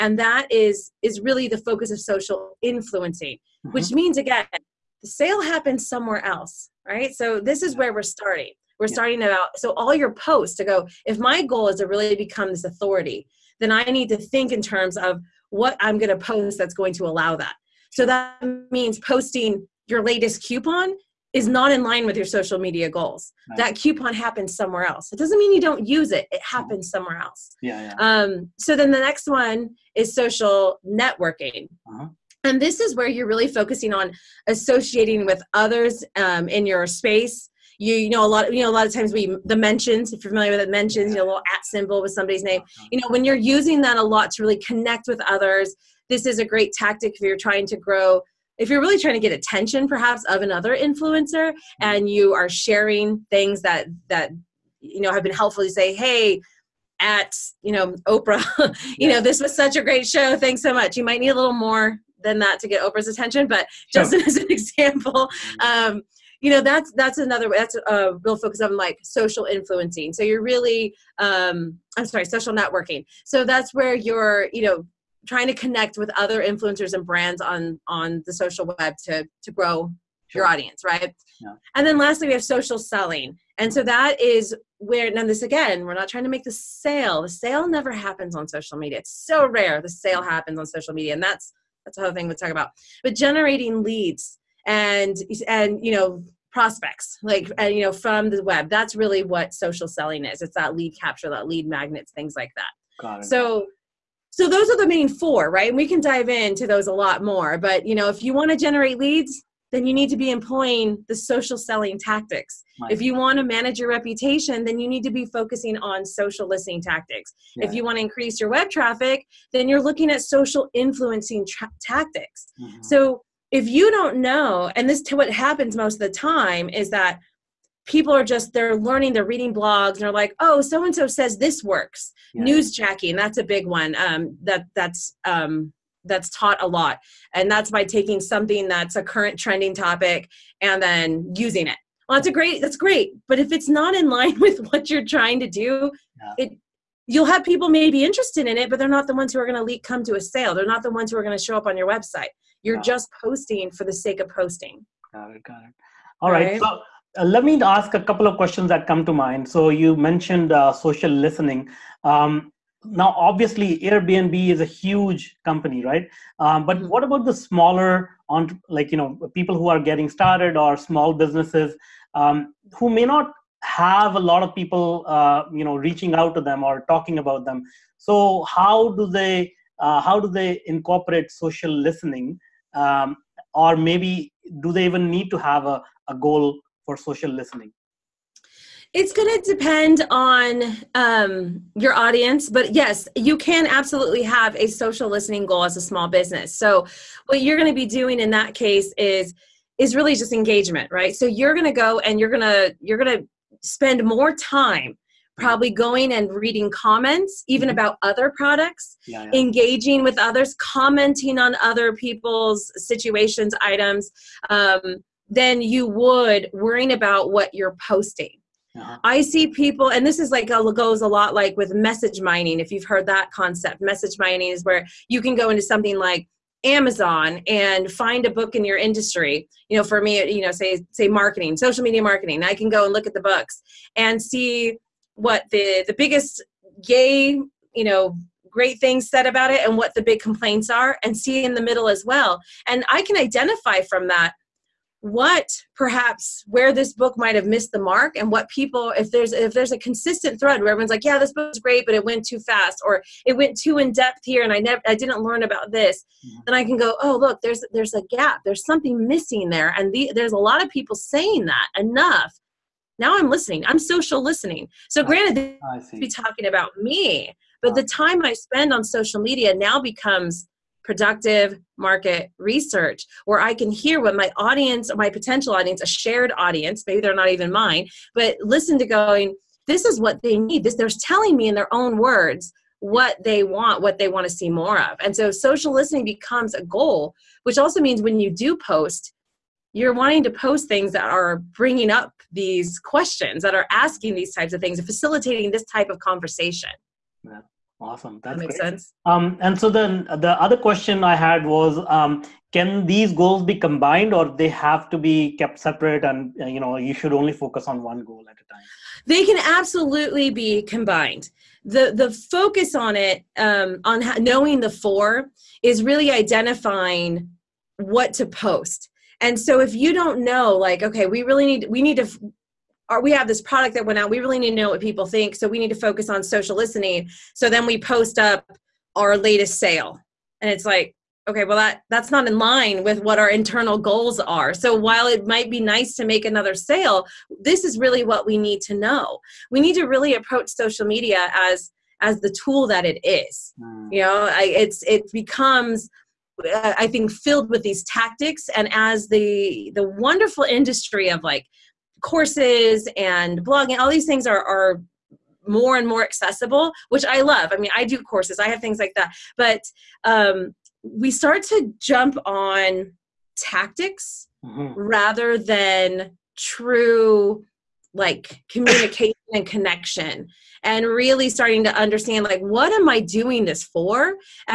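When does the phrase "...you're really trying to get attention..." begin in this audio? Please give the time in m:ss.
0:48.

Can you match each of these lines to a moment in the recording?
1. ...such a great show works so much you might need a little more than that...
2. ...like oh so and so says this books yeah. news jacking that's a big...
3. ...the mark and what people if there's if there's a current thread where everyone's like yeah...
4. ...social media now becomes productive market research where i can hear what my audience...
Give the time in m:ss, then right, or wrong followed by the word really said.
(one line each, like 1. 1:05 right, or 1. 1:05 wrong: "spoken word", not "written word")
1. 0:59 wrong: "thanks", not "works"
2. 2:10 wrong: "works", not "books"
3. 4:07 wrong: "consistent", not "current"
4. 4:28 right.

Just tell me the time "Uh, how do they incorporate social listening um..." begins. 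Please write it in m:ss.
2:59.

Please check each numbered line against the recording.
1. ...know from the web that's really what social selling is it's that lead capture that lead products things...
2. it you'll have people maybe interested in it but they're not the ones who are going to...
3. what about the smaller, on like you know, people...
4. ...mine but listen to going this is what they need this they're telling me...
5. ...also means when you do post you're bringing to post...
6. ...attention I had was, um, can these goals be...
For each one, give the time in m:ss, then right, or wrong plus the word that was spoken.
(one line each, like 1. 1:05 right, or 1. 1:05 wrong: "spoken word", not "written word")
1. 1:37 wrong: "magnets", not "products"
2. 2:26 right
3. 2:46 right
4. 4:37 right
5. 4:47 wrong: "wanting", not "bringing"
6. 5:00 wrong: "question", not "attention".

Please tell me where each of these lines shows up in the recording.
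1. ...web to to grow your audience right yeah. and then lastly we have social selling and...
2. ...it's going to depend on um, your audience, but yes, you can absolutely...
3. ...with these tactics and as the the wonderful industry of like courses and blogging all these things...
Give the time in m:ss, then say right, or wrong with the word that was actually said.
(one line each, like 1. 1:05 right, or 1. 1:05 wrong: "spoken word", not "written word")
1. 1:18 right
2. 3:08 right
3. 5:47 right.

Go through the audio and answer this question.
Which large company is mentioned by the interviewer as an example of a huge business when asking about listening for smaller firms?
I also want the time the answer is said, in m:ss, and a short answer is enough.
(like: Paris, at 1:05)
Airbnb, at 2:43.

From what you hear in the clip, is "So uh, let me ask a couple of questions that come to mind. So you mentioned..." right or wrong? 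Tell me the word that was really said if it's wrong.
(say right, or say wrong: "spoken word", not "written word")
right.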